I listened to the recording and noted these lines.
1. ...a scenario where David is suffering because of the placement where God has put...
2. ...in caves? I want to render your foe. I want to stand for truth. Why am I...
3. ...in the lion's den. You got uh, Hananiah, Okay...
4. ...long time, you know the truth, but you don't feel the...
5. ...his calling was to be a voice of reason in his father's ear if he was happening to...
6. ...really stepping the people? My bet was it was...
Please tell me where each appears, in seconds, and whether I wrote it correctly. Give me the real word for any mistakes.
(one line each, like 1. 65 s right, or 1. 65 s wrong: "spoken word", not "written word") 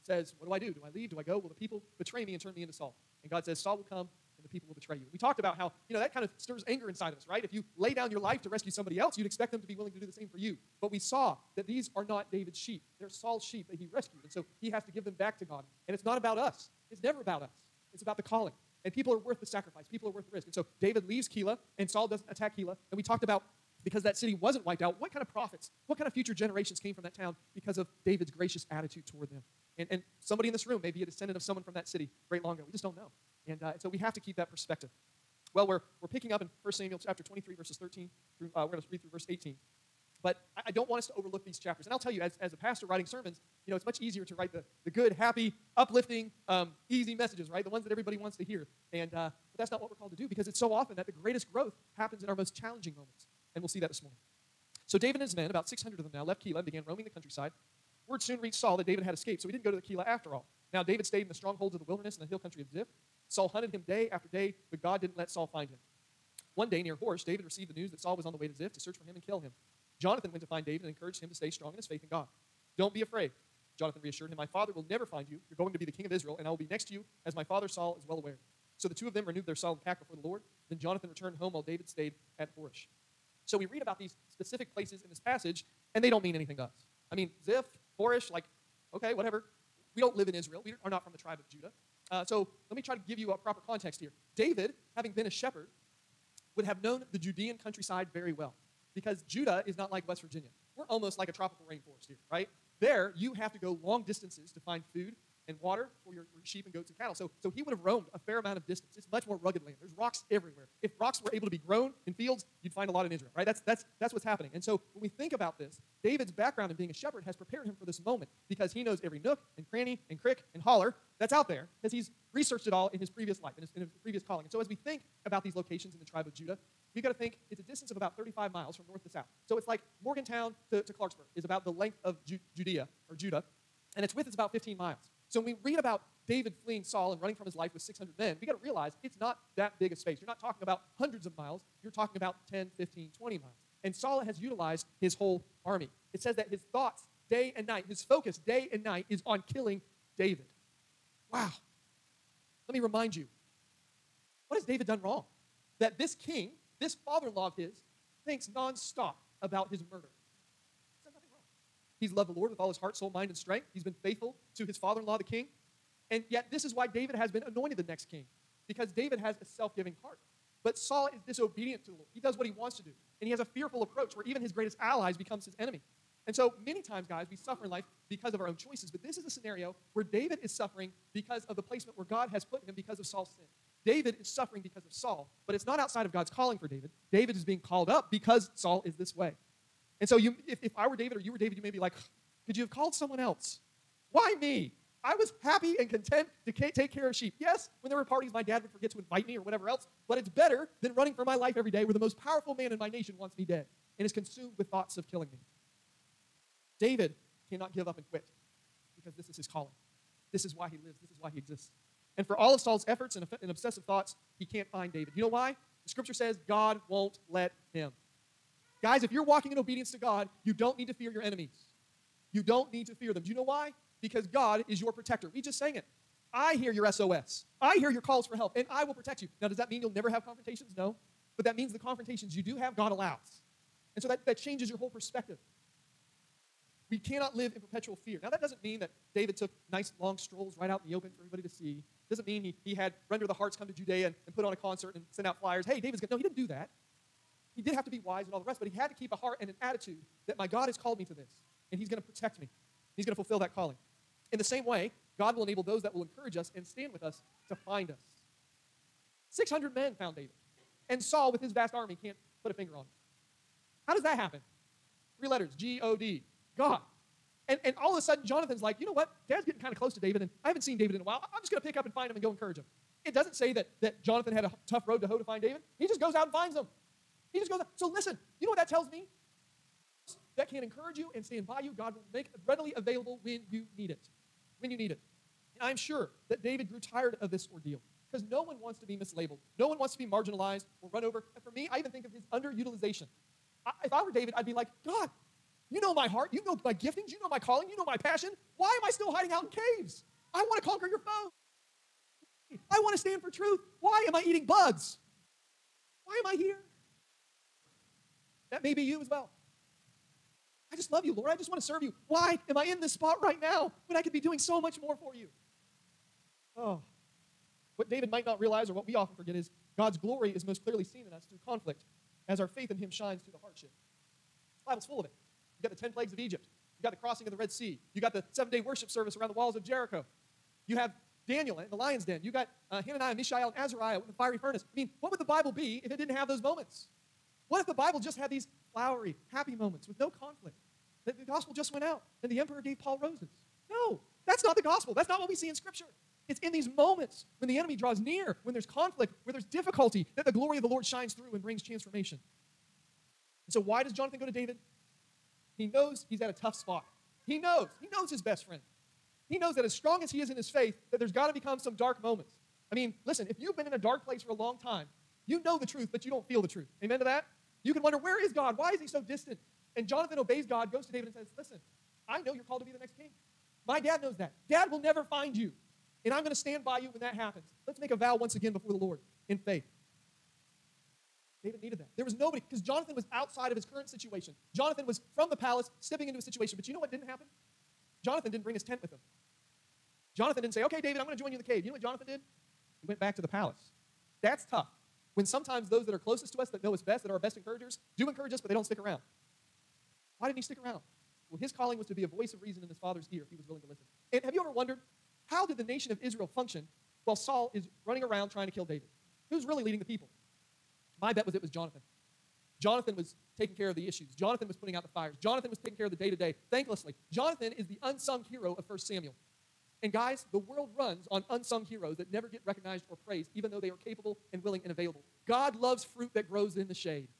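1. 179 s right
2. 299 s wrong: "conquer", not "render"
3. 331 s wrong: "Mishael", not "Okay"
4. 364 s right
5. 401 s wrong: "willing", not "happening"
6. 409 s wrong: "leading", not "stepping".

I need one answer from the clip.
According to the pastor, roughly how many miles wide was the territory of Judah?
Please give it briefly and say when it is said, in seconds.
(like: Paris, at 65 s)
15 miles, at 134 s.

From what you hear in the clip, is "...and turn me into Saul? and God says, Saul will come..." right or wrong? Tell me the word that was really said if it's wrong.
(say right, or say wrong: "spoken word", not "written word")
right.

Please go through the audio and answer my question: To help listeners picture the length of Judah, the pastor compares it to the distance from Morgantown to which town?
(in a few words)
Clarksburg.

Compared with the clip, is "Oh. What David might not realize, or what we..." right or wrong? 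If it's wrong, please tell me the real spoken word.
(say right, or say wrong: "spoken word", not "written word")
right.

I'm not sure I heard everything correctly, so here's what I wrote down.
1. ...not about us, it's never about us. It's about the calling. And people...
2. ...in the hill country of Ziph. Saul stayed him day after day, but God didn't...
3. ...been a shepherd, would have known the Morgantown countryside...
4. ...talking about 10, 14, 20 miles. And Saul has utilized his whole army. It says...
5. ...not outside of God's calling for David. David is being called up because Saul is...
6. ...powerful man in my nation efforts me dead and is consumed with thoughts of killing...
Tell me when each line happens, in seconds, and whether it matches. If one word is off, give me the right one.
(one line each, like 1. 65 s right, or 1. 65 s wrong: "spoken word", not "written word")
1. 16 s right
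2. 62 s wrong: "hunted", not "stayed"
3. 95 s wrong: "Judean", not "Morgantown"
4. 141 s wrong: "15", not "14"
5. 185 s right
6. 202 s wrong: "wants", not "efforts".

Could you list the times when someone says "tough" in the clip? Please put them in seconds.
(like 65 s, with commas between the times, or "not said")
274 s, 356 s, 394 s.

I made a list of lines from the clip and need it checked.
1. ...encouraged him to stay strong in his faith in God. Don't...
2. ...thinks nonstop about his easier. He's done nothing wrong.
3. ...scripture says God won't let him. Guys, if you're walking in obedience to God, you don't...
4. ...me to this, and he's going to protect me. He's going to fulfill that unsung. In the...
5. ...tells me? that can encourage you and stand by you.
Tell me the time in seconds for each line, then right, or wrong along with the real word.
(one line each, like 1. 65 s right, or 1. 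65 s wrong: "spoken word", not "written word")
1. 70 s right
2. 158 s wrong: "murder", not "easier"
3. 215 s right
4. 250 s wrong: "calling", not "unsung"
5. 278 s right.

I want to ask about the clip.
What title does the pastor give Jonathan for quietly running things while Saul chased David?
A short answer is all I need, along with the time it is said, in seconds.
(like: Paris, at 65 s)
Unsung hero of 1 Samuel, at 417 s.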